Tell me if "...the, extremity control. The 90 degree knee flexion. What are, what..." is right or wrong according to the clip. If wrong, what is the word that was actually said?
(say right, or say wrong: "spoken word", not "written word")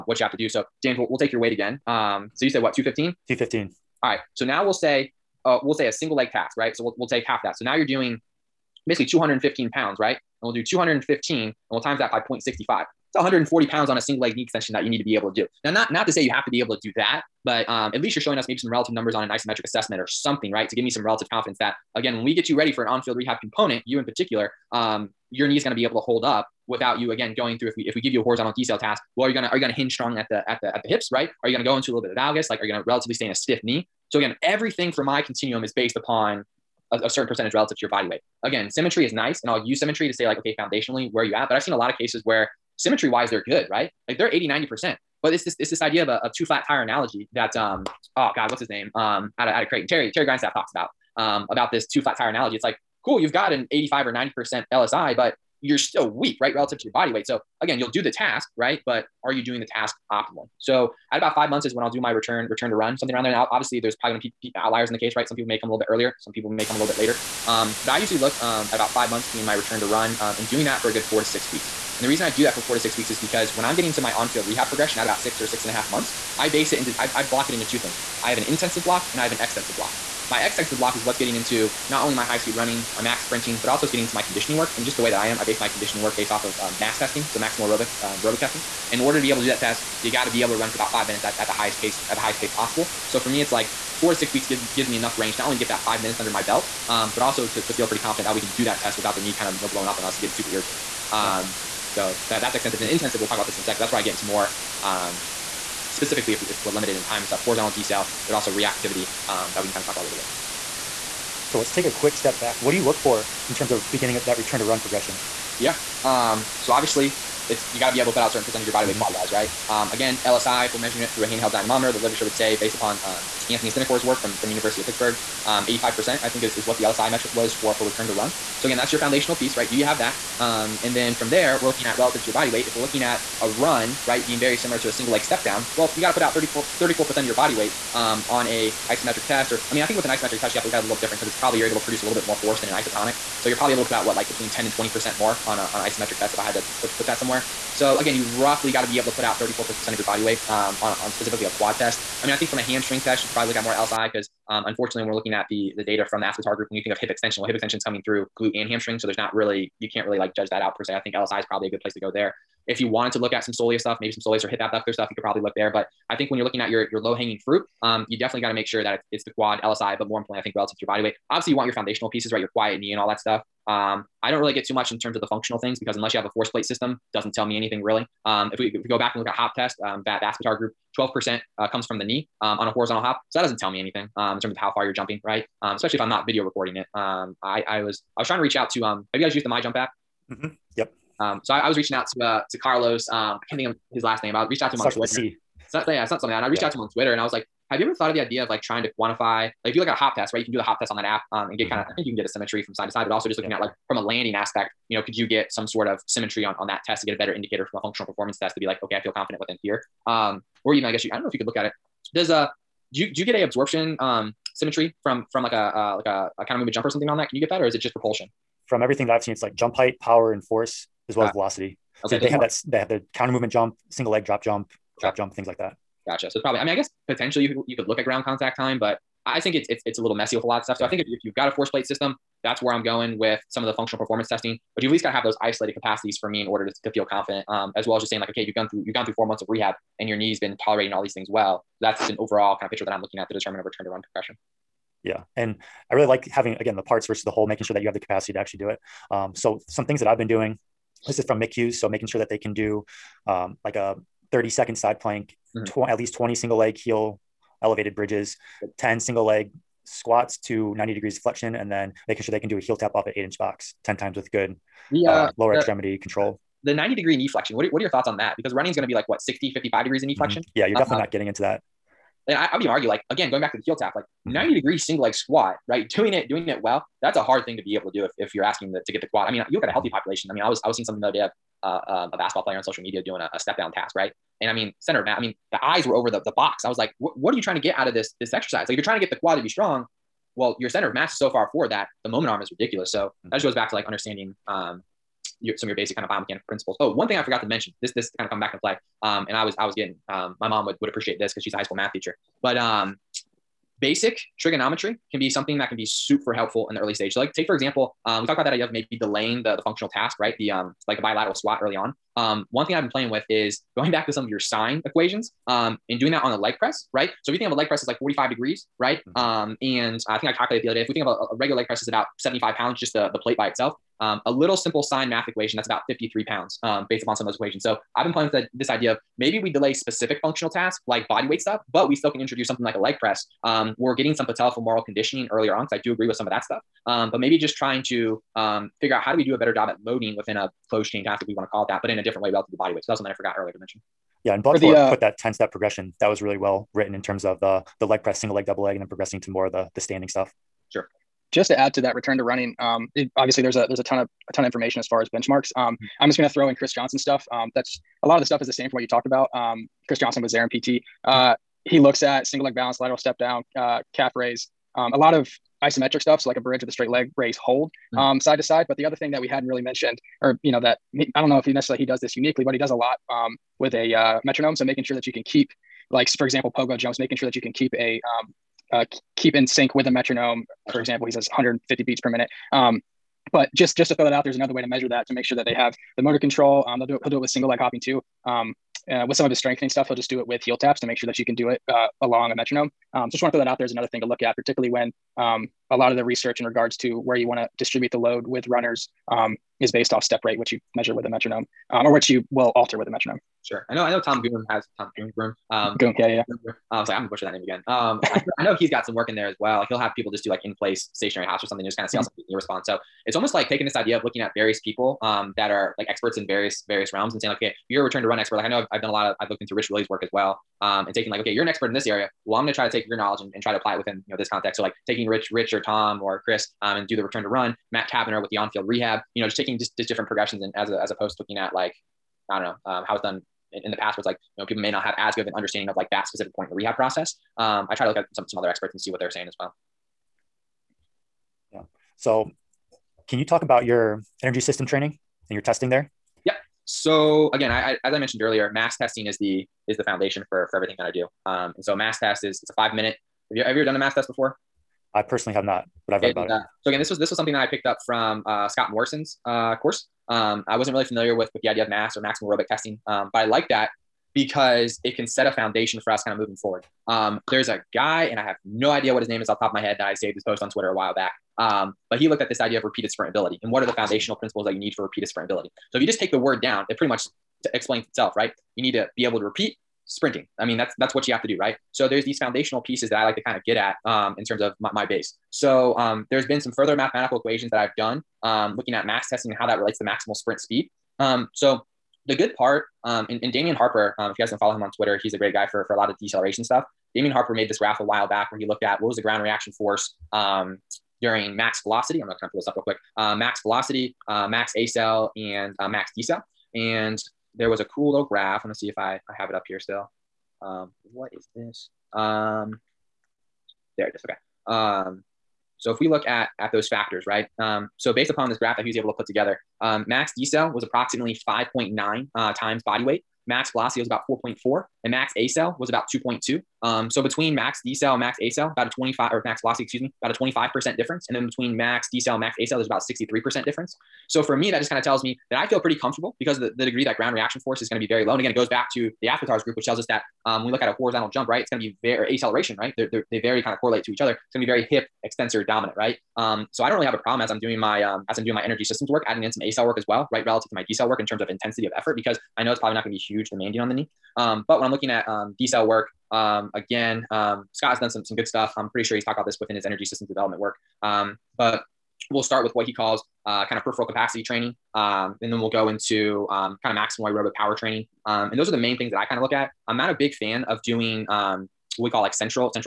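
right.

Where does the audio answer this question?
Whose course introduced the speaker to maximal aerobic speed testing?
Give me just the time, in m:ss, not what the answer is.
7:38.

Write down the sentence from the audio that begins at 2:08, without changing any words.
So again, that's your foundational piece, right?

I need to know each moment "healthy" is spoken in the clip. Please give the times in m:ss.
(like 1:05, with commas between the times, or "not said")
4:39.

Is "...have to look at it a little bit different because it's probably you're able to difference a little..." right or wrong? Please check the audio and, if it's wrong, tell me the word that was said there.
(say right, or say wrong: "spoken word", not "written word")
wrong: "produce", not "difference".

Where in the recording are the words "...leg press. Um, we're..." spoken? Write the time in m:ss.
5:32.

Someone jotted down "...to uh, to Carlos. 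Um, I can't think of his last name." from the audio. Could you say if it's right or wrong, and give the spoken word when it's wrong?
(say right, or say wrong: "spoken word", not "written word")
right.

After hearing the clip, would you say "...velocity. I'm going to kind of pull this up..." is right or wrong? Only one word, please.
right.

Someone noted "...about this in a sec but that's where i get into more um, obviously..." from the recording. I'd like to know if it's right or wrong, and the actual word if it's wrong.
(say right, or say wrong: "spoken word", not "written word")
wrong: "specifically", not "obviously".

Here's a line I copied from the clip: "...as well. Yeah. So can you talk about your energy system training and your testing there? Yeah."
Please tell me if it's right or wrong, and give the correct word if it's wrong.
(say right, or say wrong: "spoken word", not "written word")
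right.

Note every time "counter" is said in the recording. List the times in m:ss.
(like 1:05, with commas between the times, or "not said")
3:36, 3:43.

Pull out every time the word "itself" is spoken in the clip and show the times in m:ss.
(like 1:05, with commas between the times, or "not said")
5:23, 7:57.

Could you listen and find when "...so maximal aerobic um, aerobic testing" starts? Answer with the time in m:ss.
1:27.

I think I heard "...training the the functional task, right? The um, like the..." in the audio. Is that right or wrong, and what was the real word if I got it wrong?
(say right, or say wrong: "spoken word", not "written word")
wrong: "delaying", not "training".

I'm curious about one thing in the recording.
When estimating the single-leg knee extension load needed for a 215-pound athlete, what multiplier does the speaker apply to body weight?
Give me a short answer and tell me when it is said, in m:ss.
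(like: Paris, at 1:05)
0.65, at 0:12.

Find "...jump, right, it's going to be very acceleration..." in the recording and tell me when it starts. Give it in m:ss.
9:01.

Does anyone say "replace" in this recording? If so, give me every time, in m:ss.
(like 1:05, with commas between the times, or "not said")
not said.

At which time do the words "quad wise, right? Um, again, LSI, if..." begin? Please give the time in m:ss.
1:59.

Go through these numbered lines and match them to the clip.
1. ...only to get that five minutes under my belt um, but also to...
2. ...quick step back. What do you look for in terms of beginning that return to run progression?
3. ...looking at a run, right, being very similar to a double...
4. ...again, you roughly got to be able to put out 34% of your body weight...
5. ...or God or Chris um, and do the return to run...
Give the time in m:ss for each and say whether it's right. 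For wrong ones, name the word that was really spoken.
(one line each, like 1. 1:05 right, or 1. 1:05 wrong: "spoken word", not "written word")
1. 1:35 right
2. 1:51 right
3. 2:12 wrong: "single", not "double"
4. 2:27 right
5. 7:05 wrong: "Tom", not "God".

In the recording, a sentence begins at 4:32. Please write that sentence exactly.
And I, I, would even argue, like again, going back to the heel tap, like mm-hmm.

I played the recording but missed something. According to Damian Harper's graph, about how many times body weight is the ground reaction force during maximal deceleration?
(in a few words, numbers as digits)
5.9.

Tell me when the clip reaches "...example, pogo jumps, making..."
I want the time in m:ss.
6:16.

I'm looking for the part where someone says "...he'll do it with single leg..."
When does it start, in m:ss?
6:27.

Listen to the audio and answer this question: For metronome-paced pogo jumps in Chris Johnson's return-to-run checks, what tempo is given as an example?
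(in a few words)
150 beats per minute.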